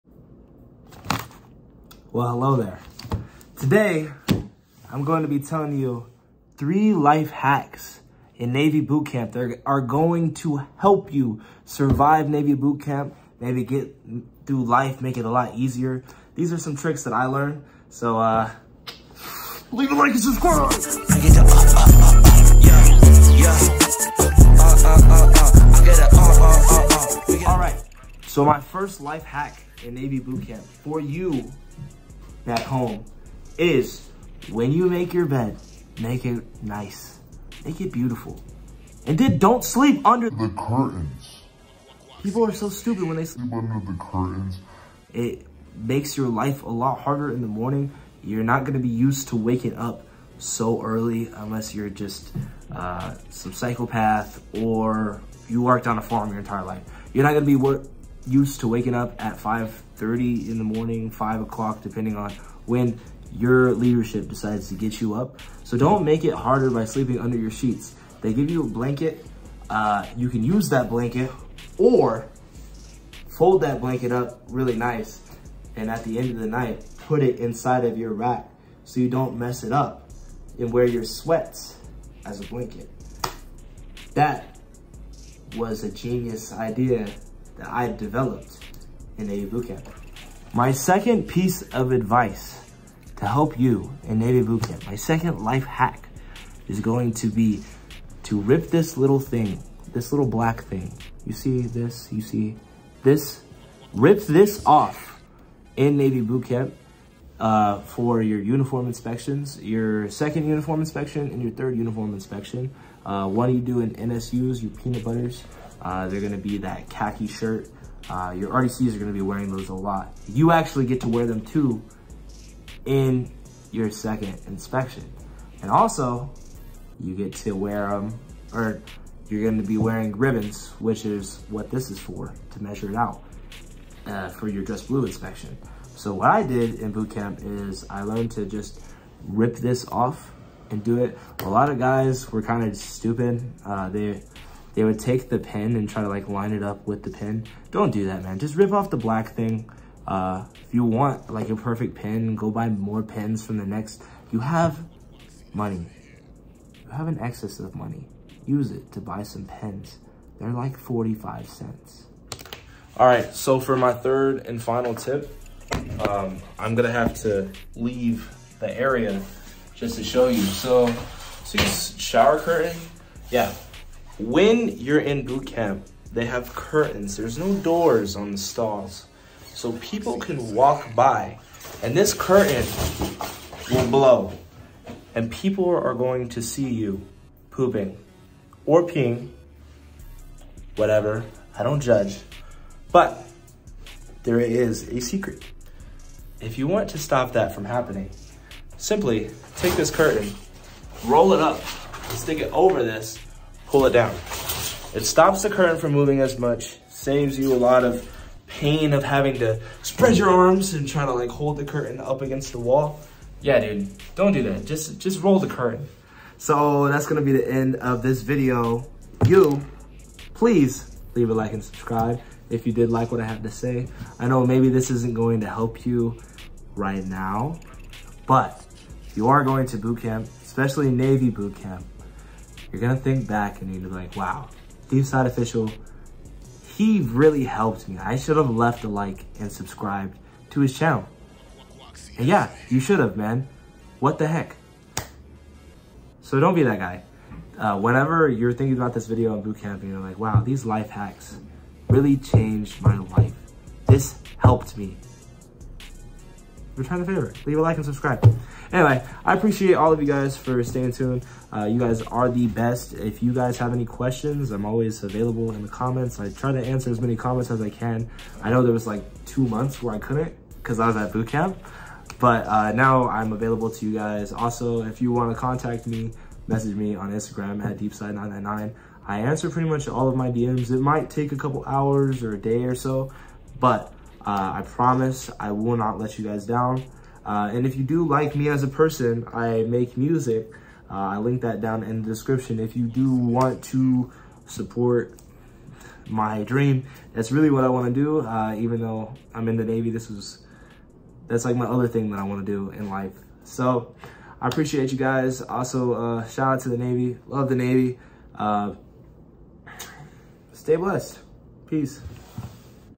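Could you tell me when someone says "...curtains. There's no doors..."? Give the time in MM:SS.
02:56.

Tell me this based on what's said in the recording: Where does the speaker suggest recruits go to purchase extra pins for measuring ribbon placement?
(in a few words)
The NEX.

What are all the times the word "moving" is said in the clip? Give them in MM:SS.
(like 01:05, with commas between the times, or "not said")
03:25.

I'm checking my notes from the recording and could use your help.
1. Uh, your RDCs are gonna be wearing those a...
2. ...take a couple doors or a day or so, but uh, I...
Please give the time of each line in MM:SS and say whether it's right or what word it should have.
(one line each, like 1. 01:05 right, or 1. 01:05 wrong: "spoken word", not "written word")
1. 01:58 right
2. 04:41 wrong: "hours", not "doors".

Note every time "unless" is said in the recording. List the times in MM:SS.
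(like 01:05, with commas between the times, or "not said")
00:51.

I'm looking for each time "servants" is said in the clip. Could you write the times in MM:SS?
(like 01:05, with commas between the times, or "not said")
not said.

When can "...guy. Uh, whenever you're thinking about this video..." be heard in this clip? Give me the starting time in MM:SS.
04:06.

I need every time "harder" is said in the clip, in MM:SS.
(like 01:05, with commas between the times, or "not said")
00:47, 01:06.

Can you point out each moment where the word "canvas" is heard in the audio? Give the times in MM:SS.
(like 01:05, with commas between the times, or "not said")
not said.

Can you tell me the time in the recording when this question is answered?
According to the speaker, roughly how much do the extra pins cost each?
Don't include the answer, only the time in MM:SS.
02:40.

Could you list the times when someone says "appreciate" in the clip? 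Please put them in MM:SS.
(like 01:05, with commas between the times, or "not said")
04:19, 05:04.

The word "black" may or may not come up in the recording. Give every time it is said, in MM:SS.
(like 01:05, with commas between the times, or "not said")
01:40, 02:28.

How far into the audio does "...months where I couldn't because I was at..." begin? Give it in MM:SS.
04:29.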